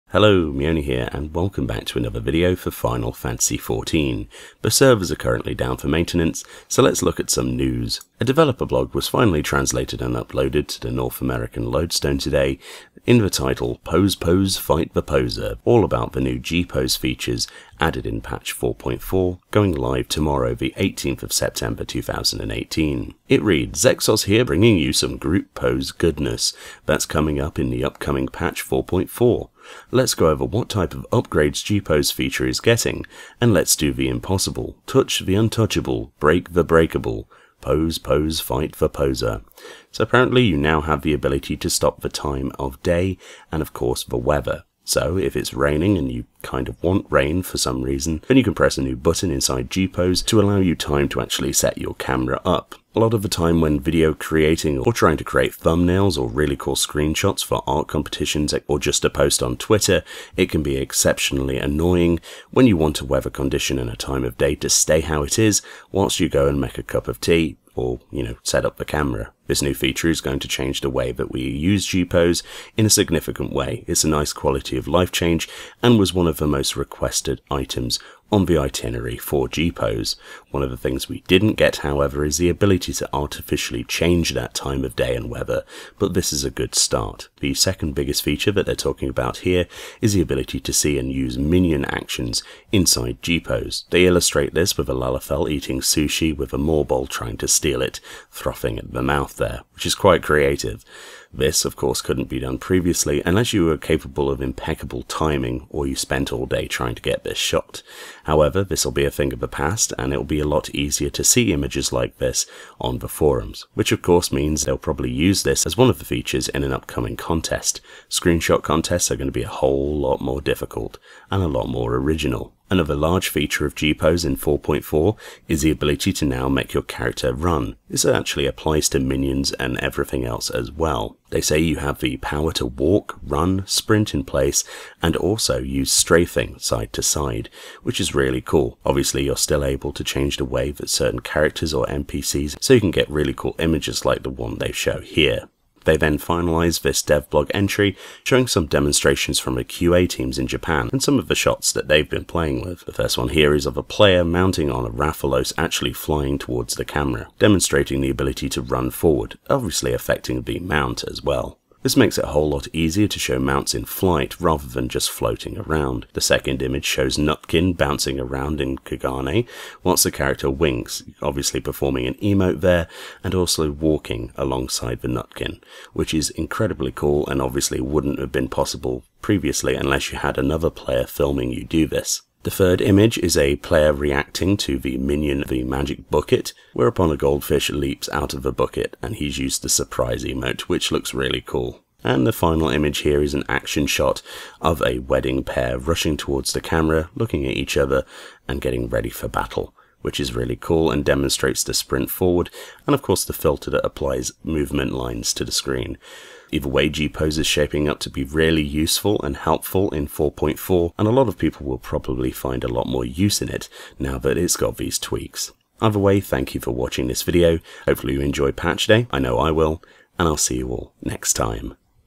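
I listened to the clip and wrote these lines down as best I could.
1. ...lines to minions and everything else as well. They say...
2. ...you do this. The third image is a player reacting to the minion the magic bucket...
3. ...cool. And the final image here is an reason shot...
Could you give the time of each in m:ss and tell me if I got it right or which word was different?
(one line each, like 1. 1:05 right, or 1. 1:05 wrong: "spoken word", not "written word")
1. 2:08 wrong: "applies", not "lines"
2. 3:01 right
3. 3:11 wrong: "action", not "reason".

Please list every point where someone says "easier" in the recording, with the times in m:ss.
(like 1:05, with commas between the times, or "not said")
1:50, 2:42.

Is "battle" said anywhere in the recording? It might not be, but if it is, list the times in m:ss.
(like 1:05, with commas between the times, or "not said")
3:19.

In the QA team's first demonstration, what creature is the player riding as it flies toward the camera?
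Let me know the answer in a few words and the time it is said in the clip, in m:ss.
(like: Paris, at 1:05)
Rathalos, at 2:34.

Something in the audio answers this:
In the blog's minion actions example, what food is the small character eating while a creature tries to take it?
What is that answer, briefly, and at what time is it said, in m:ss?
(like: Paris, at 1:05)
Sushi, at 1:35.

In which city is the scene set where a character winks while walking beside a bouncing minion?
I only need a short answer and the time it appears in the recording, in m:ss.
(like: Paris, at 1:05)
Kugane, at 2:48.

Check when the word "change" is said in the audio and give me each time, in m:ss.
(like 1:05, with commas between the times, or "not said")
1:10, 1:15, 1:23, 2:20.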